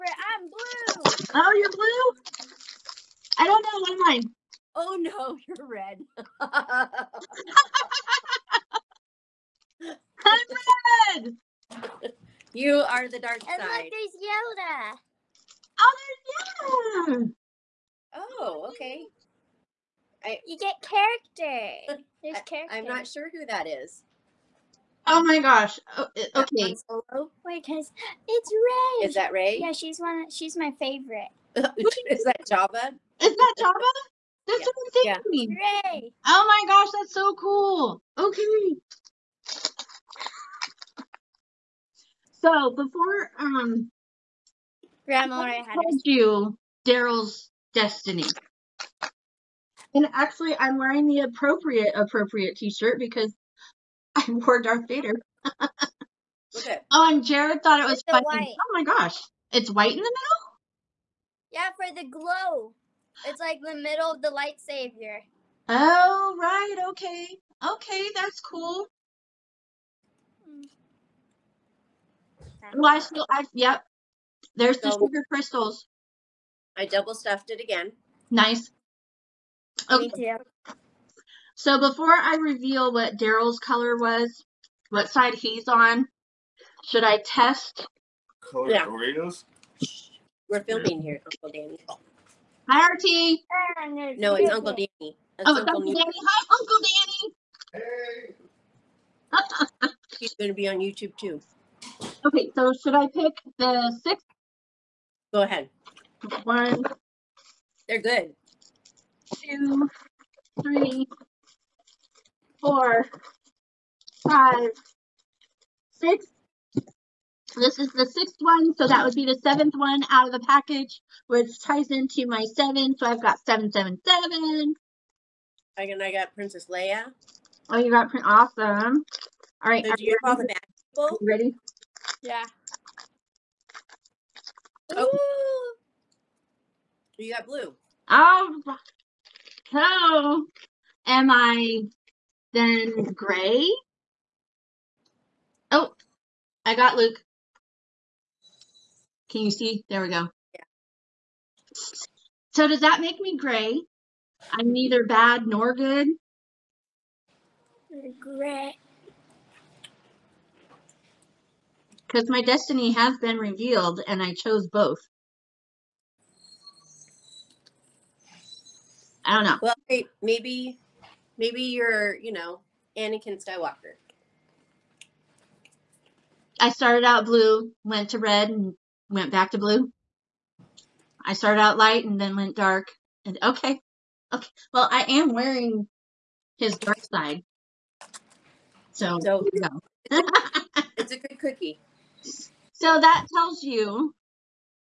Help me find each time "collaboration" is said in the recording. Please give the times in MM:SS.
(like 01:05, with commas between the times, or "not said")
not said.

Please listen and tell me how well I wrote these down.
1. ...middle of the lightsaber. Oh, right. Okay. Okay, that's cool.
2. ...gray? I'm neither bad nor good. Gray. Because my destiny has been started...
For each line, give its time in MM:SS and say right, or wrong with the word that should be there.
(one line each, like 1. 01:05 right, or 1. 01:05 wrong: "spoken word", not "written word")
1. 01:03 right
2. 02:33 wrong: "revealed", not "started".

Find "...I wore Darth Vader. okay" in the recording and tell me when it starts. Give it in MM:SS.
00:54.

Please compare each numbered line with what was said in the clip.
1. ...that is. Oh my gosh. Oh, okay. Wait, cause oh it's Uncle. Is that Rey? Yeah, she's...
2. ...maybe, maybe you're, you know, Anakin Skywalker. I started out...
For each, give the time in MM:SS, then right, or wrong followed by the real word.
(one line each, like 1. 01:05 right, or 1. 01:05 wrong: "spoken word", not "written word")
1. 00:23 wrong: "Rey", not "Uncle"
2. 02:50 right.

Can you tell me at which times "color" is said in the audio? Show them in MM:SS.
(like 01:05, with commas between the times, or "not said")
01:23, 01:28.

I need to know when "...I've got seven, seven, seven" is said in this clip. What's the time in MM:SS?
02:03.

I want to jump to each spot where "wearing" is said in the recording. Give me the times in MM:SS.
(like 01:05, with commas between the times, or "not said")
00:50, 03:05.